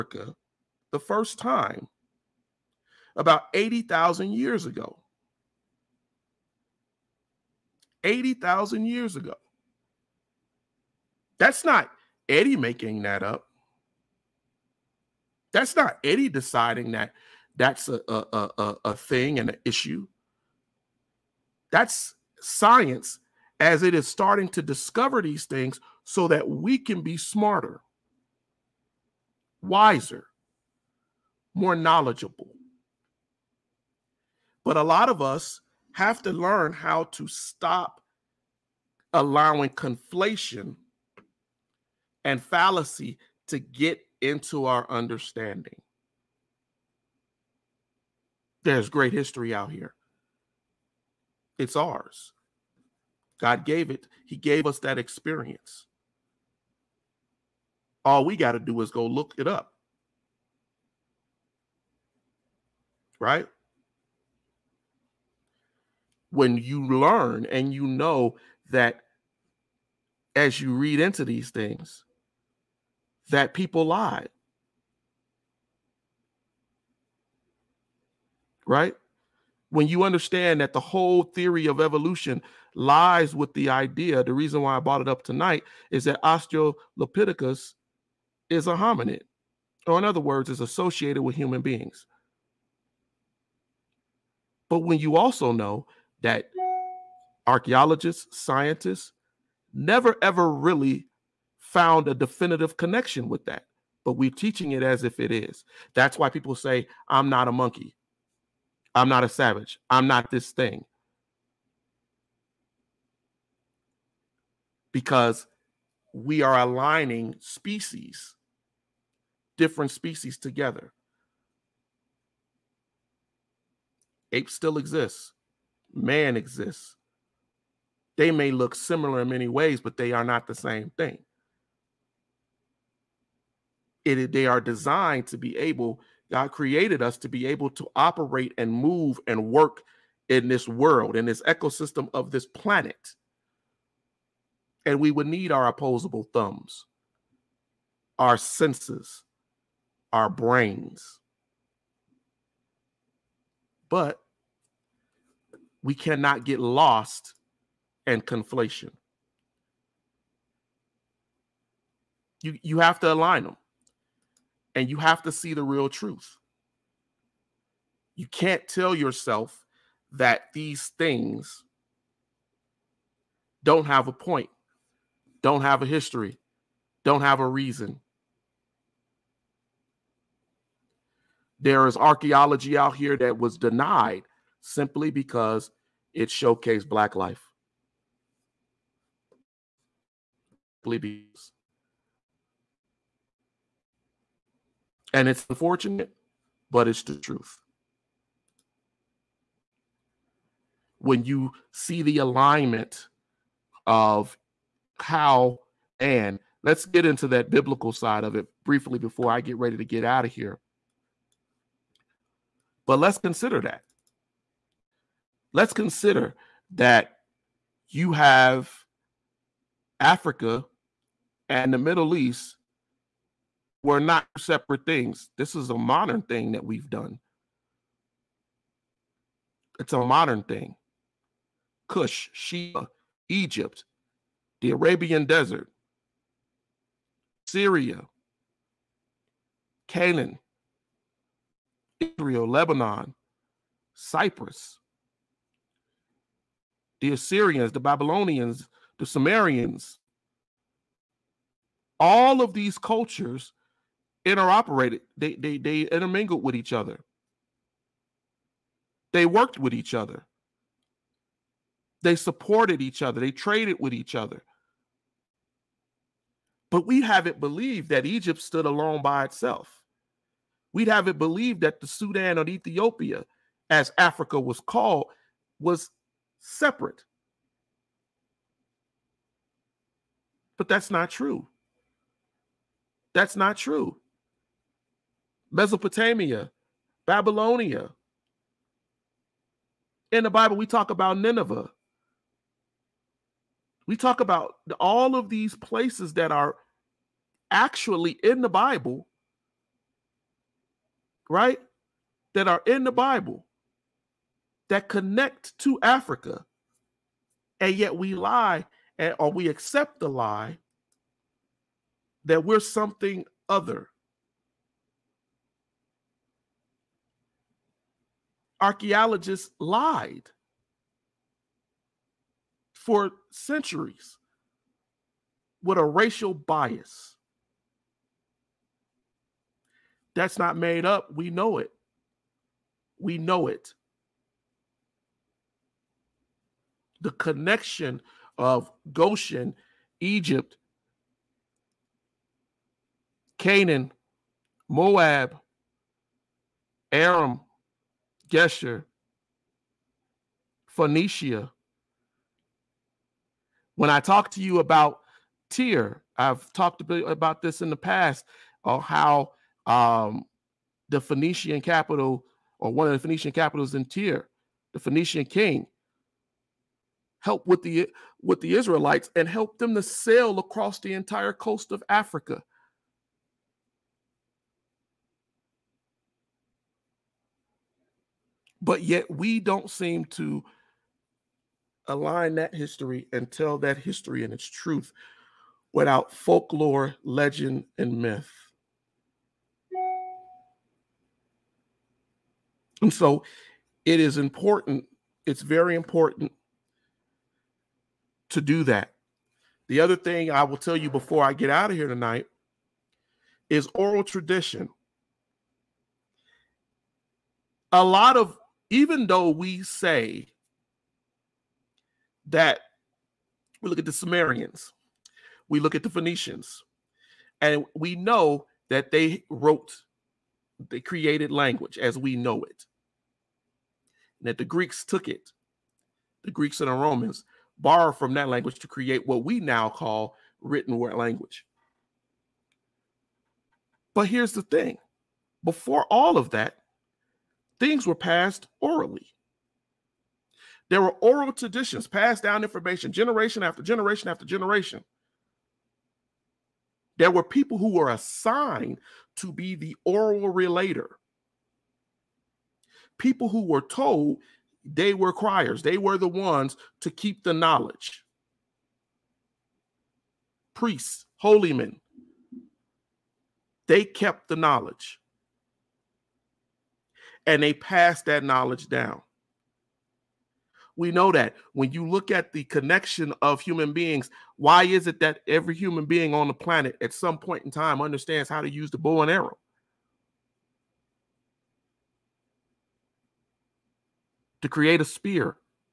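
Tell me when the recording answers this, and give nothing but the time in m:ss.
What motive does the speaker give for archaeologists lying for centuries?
5:25.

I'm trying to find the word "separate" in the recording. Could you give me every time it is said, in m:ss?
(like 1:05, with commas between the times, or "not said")
3:44, 4:36.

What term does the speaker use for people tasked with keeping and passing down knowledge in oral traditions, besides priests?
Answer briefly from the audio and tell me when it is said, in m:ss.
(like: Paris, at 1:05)
Criers, at 7:35.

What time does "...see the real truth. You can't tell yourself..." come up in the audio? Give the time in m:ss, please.
2:45.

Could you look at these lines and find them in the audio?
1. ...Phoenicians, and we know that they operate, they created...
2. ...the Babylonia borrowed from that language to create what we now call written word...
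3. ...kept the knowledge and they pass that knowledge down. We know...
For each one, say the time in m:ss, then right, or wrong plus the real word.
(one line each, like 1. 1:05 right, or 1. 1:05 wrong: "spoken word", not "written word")
1. 6:55 wrong: "wrote", not "operate"
2. 7:06 wrong: "Romans", not "Babylonia"
3. 7:43 right.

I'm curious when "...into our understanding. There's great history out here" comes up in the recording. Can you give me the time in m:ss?
0:44.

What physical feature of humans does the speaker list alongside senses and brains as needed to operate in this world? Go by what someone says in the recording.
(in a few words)
Opposable thumbs.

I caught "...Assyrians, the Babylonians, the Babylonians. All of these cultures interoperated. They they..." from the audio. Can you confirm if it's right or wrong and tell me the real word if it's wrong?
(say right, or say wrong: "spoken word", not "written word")
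wrong: "Sumerians", not "Babylonians".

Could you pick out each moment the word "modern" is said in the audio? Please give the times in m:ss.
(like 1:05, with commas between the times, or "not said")
3:45, 3:49.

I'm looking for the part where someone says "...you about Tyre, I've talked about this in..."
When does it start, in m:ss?
5:54.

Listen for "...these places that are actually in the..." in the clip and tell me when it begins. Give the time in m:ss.
4:55.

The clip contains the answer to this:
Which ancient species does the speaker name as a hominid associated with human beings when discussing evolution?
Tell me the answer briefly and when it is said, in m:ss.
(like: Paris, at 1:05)
Australopithecus, at 1:26.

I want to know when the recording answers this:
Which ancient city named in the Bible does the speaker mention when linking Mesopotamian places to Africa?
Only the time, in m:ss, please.
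4:51.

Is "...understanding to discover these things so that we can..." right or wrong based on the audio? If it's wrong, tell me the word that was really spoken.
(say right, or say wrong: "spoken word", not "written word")
wrong: "starting", not "understanding".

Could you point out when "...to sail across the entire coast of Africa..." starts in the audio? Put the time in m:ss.
6:09.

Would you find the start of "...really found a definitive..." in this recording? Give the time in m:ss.
1:40.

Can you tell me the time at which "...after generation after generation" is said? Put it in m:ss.
7:23.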